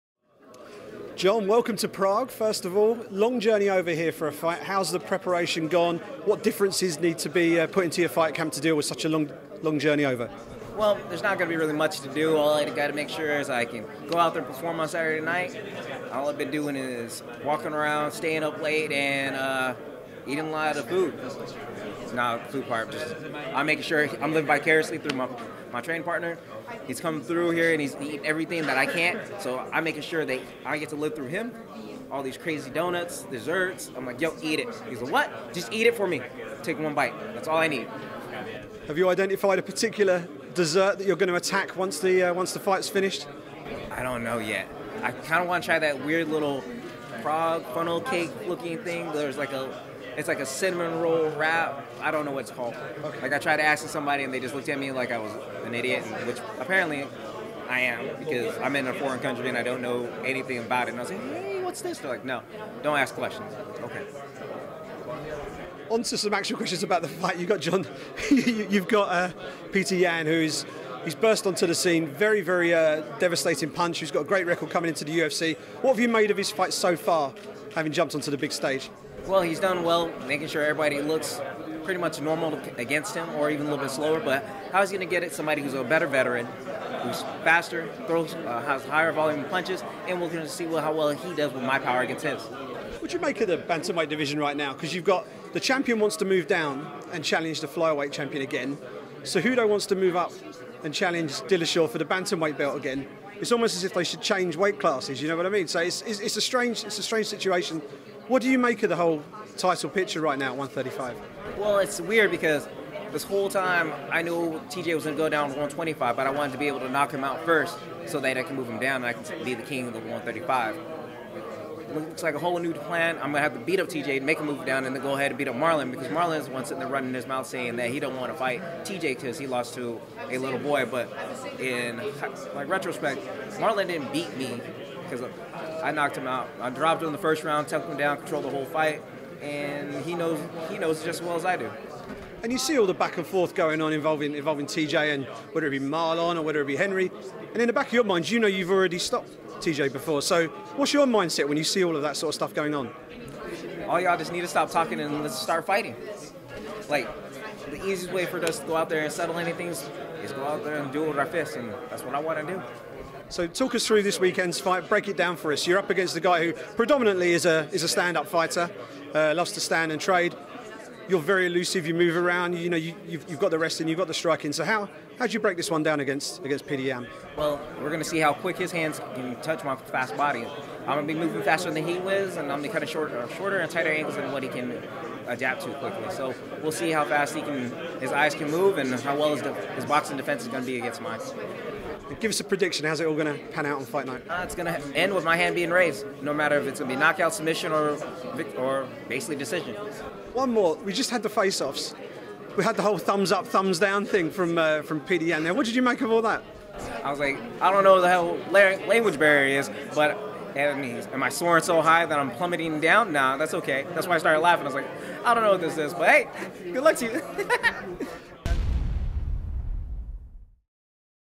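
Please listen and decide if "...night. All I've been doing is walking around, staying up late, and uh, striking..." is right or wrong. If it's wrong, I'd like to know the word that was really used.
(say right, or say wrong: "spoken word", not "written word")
wrong: "eating", not "striking".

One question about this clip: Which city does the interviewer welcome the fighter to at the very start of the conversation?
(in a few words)
Prague.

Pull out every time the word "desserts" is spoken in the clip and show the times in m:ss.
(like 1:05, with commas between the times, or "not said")
0:33, 0:40.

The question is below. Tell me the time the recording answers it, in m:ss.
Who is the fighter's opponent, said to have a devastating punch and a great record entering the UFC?
1:09.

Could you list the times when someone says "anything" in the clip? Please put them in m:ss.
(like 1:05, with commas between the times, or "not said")
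1:00, 2:39.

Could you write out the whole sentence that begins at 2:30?
So, what's your mindset when you see all of that sort of stuff going on?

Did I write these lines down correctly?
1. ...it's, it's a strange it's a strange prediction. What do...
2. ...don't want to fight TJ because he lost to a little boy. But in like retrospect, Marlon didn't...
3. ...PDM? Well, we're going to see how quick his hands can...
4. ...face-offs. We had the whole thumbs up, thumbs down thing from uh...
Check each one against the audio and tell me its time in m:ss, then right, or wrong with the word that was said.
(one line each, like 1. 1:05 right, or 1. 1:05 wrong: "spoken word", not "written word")
1. 1:46 wrong: "situation", not "prediction"
2. 2:07 right
3. 2:56 right
4. 3:21 right.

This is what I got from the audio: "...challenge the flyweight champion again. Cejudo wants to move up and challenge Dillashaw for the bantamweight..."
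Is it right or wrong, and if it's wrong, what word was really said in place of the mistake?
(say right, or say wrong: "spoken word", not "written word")
right.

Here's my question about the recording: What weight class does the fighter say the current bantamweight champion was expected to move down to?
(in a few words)
125.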